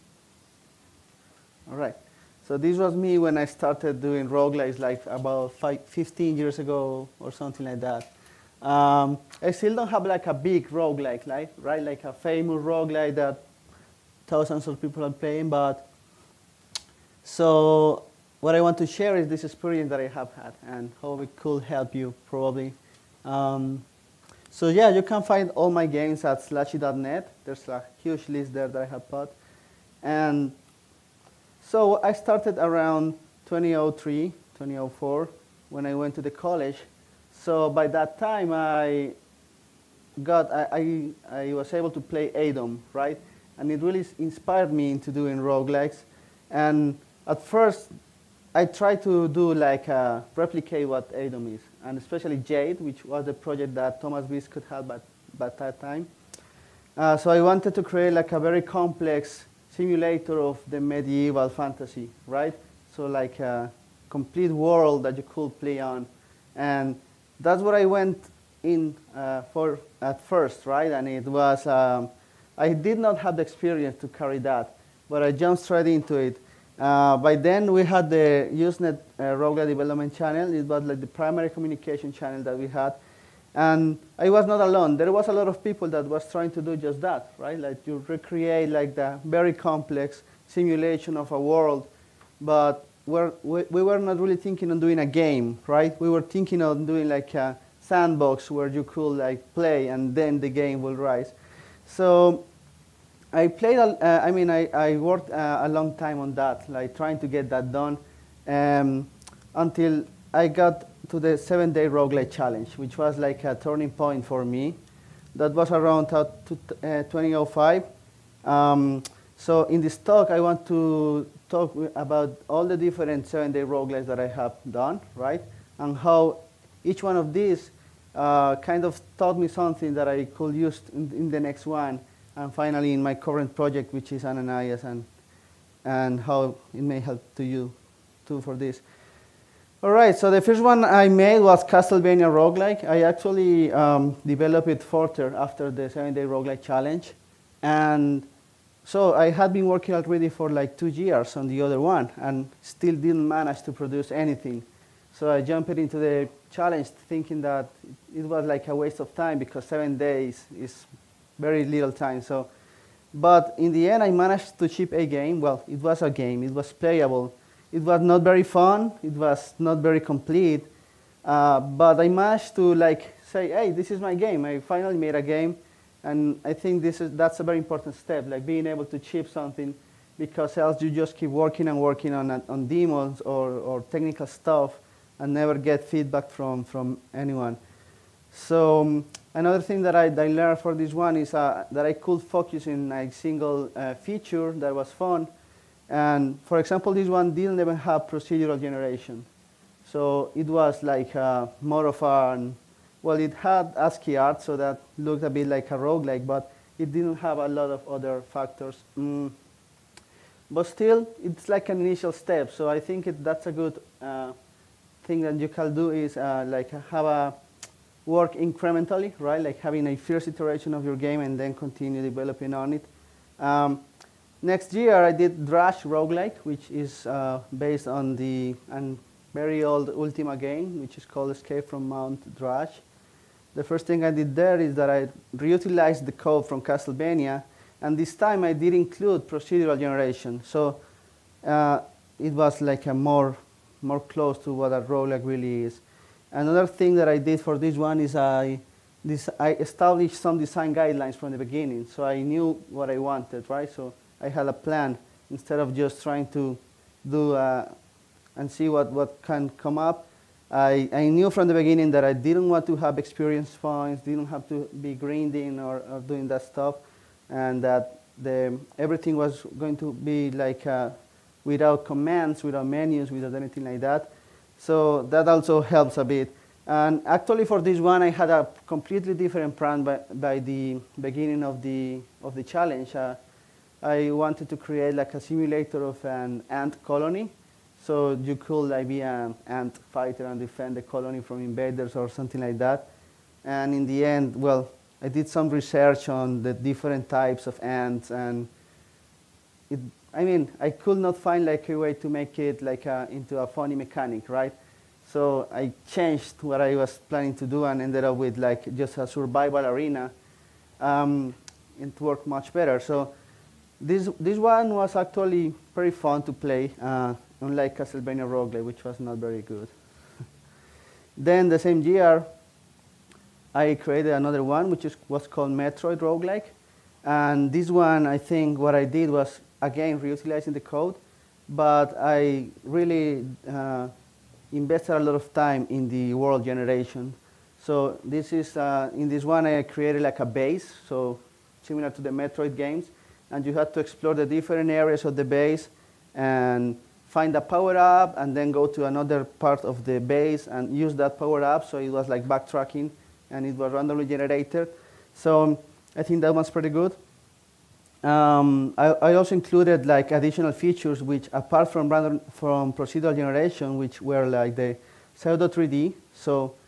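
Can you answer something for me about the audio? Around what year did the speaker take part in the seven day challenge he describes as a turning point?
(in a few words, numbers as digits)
2005.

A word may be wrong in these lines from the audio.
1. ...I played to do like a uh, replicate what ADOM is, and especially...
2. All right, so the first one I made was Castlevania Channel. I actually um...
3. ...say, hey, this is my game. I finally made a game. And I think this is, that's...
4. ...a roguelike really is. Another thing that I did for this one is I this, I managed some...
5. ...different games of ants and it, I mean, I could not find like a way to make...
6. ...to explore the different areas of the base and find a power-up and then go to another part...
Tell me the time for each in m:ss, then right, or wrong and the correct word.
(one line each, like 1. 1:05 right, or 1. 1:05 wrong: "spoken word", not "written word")
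1. 0:48 wrong: "tried", not "played"
2. 2:19 wrong: "Roguelike", not "Channel"
3. 2:53 right
4. 4:04 wrong: "established", not "managed"
5. 4:56 wrong: "types", not "games"
6. 5:43 right.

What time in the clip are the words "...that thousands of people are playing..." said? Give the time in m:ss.
0:13.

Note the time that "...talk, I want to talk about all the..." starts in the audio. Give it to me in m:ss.
1:59.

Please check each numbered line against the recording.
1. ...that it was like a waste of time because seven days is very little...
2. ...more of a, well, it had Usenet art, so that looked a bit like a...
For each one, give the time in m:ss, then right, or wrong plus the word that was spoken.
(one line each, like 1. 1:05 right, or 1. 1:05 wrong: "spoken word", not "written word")
1. 2:37 right
2. 3:21 wrong: "ASCII", not "Usenet".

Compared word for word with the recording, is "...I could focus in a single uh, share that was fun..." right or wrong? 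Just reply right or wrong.
wrong.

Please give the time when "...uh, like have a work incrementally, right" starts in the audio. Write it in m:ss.
3:36.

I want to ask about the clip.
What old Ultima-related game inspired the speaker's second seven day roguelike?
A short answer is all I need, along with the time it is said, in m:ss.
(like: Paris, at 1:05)
Escape from Mount Drash, at 3:51.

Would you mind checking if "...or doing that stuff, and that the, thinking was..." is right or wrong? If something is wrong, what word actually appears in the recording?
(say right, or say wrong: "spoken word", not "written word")
wrong: "everything", not "thinking".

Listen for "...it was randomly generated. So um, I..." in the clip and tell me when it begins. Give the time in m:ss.
5:53.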